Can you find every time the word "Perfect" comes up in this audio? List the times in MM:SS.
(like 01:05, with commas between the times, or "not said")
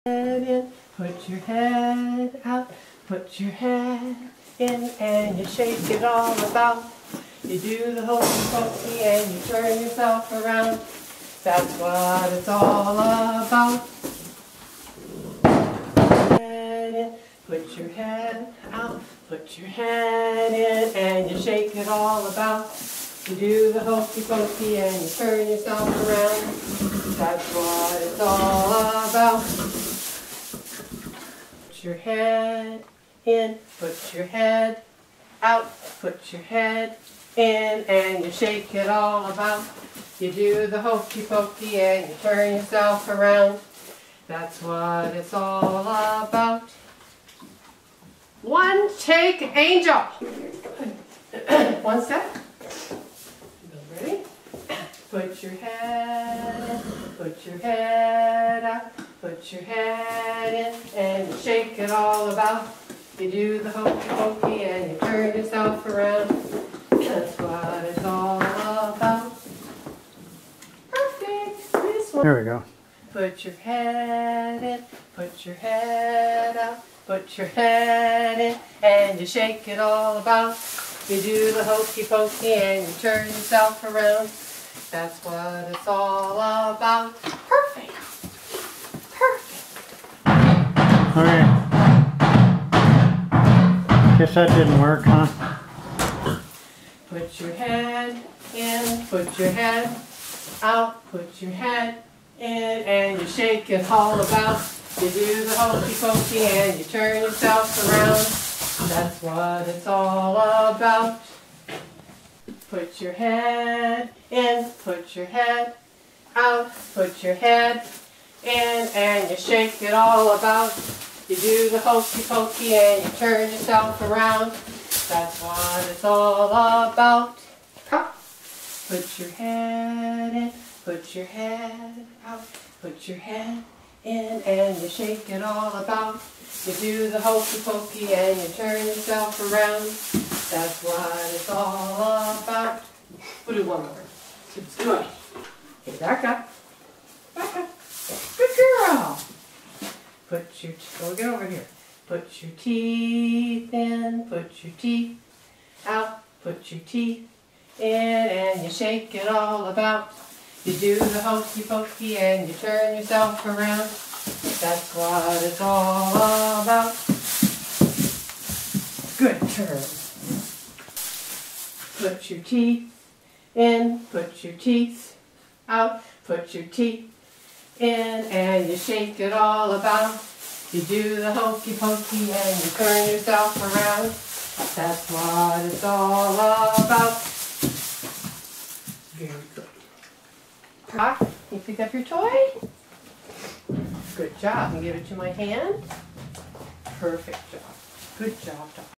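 01:10, 03:16.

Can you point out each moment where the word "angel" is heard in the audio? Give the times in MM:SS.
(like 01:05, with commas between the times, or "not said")
00:49.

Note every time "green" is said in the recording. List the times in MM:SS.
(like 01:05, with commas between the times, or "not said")
not said.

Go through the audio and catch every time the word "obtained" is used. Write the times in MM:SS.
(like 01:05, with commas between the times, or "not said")
not said.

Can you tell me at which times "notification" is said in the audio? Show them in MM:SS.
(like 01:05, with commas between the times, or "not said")
not said.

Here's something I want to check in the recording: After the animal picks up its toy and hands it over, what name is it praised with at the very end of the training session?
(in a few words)
Doc.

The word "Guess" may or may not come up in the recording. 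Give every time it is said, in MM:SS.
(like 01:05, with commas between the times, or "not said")
01:34.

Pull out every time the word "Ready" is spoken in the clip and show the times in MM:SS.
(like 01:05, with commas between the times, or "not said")
00:53.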